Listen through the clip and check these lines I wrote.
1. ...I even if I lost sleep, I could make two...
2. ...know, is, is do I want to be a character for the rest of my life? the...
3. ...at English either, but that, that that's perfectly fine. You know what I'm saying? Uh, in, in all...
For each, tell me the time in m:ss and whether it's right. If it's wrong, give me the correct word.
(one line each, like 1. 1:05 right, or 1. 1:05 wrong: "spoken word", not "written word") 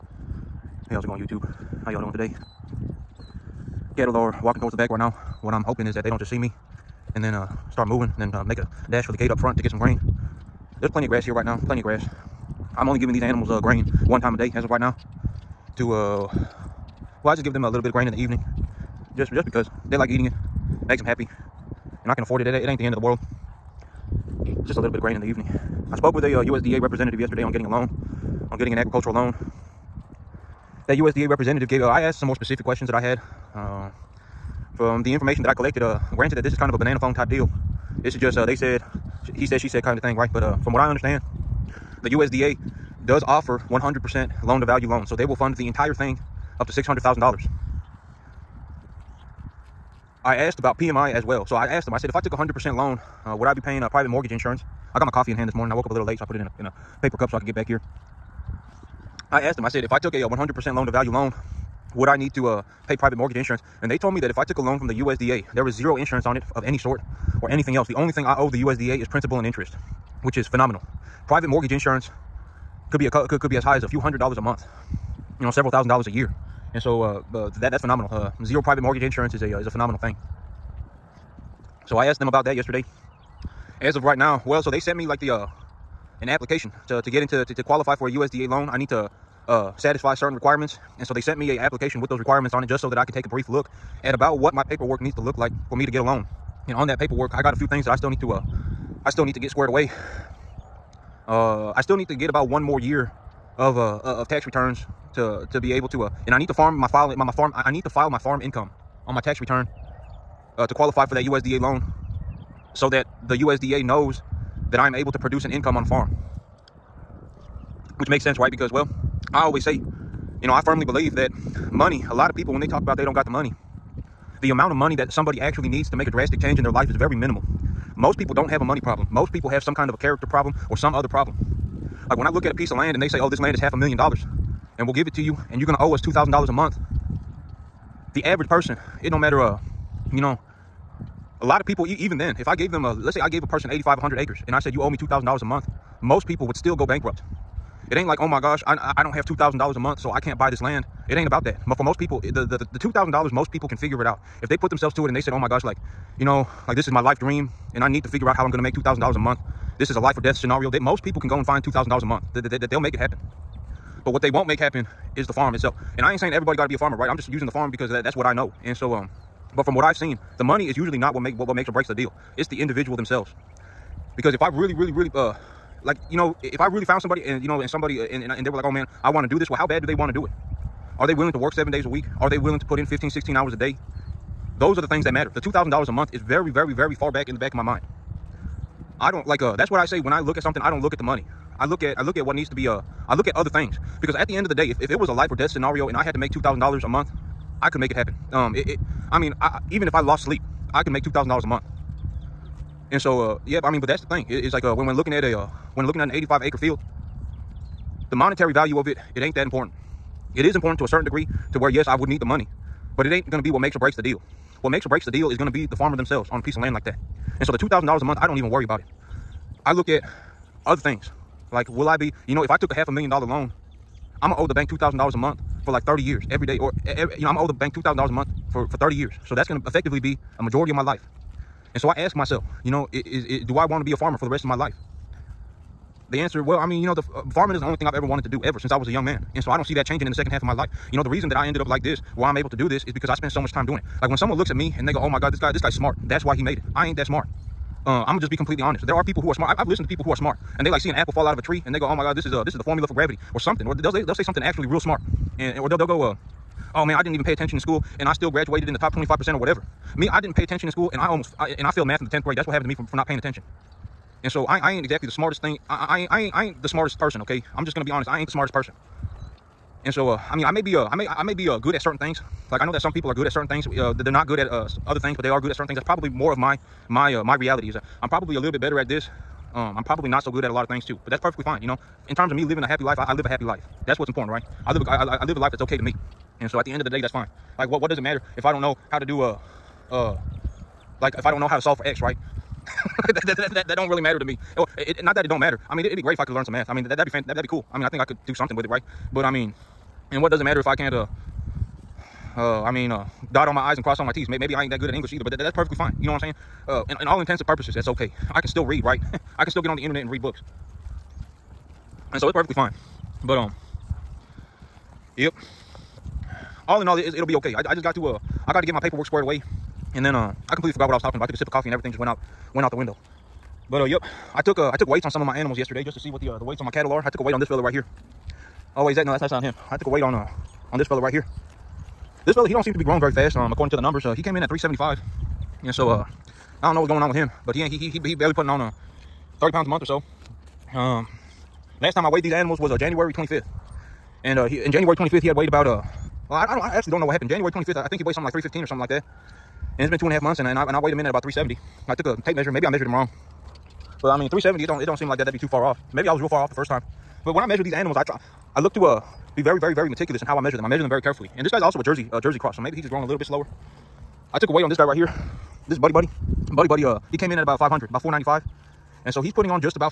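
1. 3:19 right
2. 3:52 wrong: "farmer", not "character"
3. 5:04 right.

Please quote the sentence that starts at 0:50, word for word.
I asked about PMI as well.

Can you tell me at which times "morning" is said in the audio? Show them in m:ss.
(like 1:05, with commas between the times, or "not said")
0:55.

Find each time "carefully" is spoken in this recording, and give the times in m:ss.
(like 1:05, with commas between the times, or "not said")
6:00.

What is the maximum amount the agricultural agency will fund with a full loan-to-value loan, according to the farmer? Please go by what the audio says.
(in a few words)
$600,000.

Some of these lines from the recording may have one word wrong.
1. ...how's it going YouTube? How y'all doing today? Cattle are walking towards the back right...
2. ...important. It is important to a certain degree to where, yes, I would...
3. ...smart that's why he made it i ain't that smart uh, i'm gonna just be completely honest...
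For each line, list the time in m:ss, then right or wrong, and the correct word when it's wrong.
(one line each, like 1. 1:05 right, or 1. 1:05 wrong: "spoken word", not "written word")
1. 0:00 right
2. 3:29 right
3. 4:05 right.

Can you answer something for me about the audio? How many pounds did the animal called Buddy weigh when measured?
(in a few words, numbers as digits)
495.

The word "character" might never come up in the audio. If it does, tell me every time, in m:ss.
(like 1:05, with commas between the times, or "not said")
2:09.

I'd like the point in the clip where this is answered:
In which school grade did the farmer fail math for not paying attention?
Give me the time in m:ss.
4:22.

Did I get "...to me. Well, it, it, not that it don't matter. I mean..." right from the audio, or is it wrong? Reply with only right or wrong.
right.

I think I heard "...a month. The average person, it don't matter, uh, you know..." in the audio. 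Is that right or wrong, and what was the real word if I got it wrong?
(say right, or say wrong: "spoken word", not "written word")
right.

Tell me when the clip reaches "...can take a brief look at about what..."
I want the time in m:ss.
1:33.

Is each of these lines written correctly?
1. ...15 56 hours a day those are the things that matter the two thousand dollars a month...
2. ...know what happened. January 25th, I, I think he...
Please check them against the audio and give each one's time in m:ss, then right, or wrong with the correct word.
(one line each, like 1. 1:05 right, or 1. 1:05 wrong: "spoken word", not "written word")
1. 3:02 wrong: "16", not "56"
2. 5:46 right.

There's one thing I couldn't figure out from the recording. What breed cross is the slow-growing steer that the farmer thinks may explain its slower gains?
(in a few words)
Jersey cross.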